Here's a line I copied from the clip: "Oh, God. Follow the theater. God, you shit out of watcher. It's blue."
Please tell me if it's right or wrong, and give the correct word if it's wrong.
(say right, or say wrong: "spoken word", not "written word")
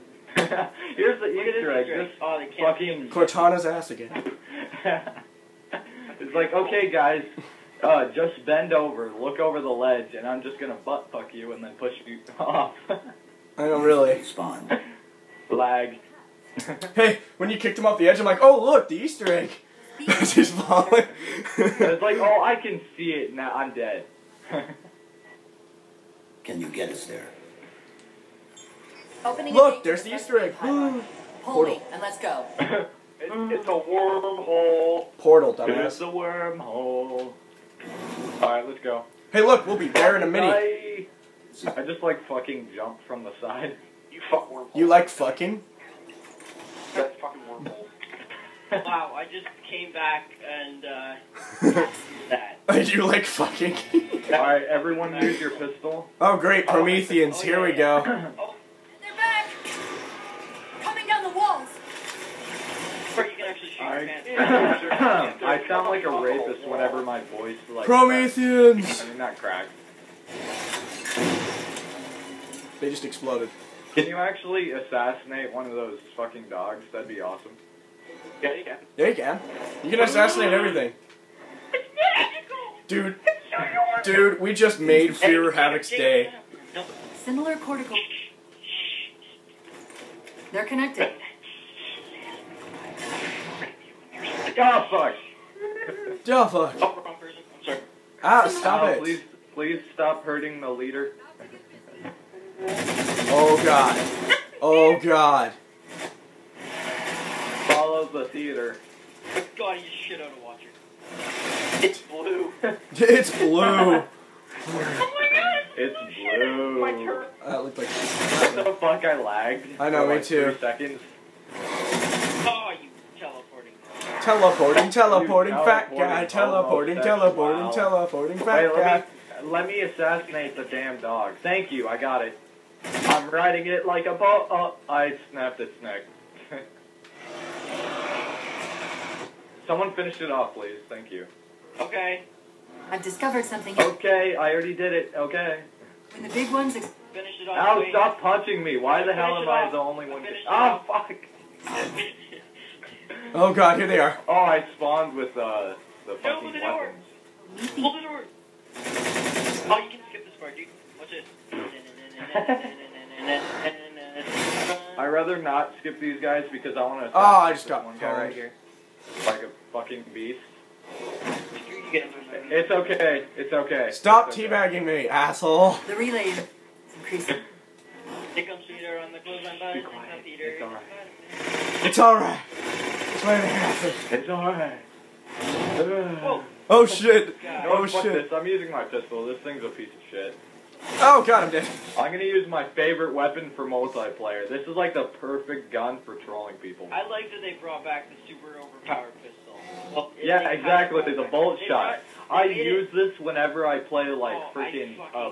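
right.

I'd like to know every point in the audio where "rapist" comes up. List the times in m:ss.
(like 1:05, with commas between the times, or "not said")
1:06.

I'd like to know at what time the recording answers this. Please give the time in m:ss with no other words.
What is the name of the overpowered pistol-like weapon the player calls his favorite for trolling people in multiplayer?
3:21.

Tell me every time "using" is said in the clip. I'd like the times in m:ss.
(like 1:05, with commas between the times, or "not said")
3:08.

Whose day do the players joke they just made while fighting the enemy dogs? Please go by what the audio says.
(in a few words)
Fear Havoc.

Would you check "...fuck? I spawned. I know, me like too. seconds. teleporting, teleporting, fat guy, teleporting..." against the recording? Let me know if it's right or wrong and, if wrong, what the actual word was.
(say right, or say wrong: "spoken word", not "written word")
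wrong: "lagged", not "spawned".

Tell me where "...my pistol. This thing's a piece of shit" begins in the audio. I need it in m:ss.
3:08.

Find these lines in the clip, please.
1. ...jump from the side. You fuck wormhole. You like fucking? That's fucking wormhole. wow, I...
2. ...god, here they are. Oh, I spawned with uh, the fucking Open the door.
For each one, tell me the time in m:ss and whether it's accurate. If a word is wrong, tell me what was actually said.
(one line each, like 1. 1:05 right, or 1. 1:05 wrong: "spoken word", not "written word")
1. 0:42 right
2. 2:33 right.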